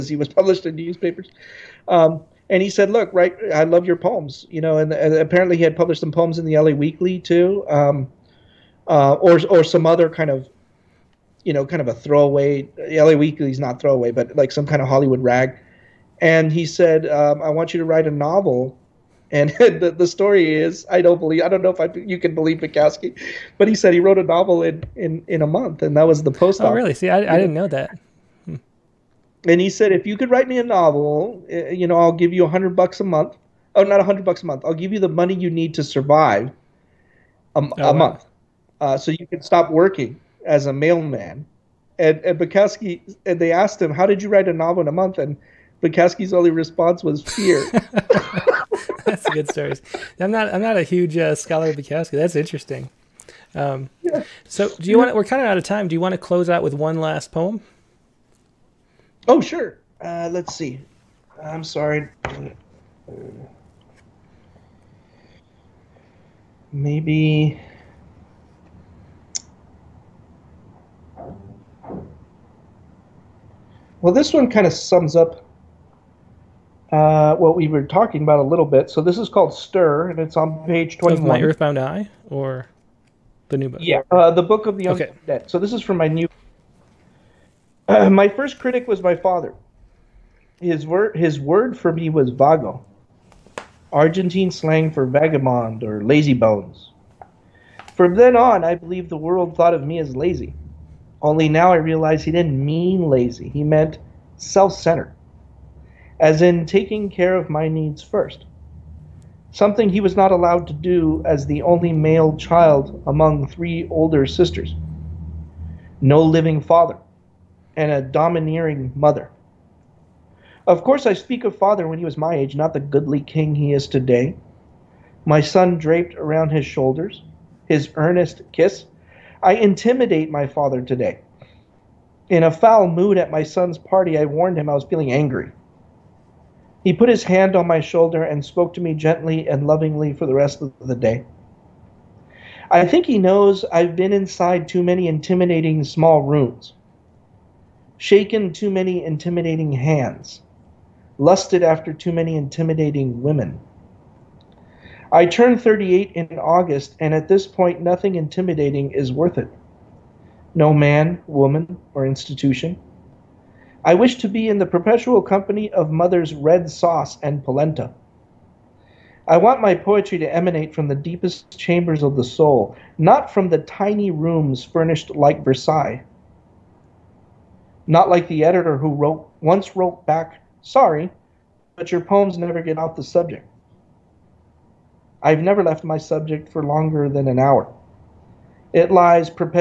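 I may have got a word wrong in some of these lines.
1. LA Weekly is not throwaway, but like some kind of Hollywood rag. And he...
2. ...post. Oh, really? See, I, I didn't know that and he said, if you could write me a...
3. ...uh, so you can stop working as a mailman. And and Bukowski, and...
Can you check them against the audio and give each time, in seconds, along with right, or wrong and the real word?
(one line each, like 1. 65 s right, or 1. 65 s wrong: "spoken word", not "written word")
1. 12 s right
2. 26 s right
3. 38 s right.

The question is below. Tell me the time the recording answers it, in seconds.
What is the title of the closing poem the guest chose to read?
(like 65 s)
79 s.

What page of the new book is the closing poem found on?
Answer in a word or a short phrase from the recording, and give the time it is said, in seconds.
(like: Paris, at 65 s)
21, at 80 s.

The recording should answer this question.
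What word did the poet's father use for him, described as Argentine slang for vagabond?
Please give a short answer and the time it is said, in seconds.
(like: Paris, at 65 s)
vago, at 92 s.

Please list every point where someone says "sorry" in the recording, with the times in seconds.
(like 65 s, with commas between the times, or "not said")
61 s, 180 s.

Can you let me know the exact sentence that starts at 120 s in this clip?
Of course, I speak of father when he was my age, not the goodly king he is today.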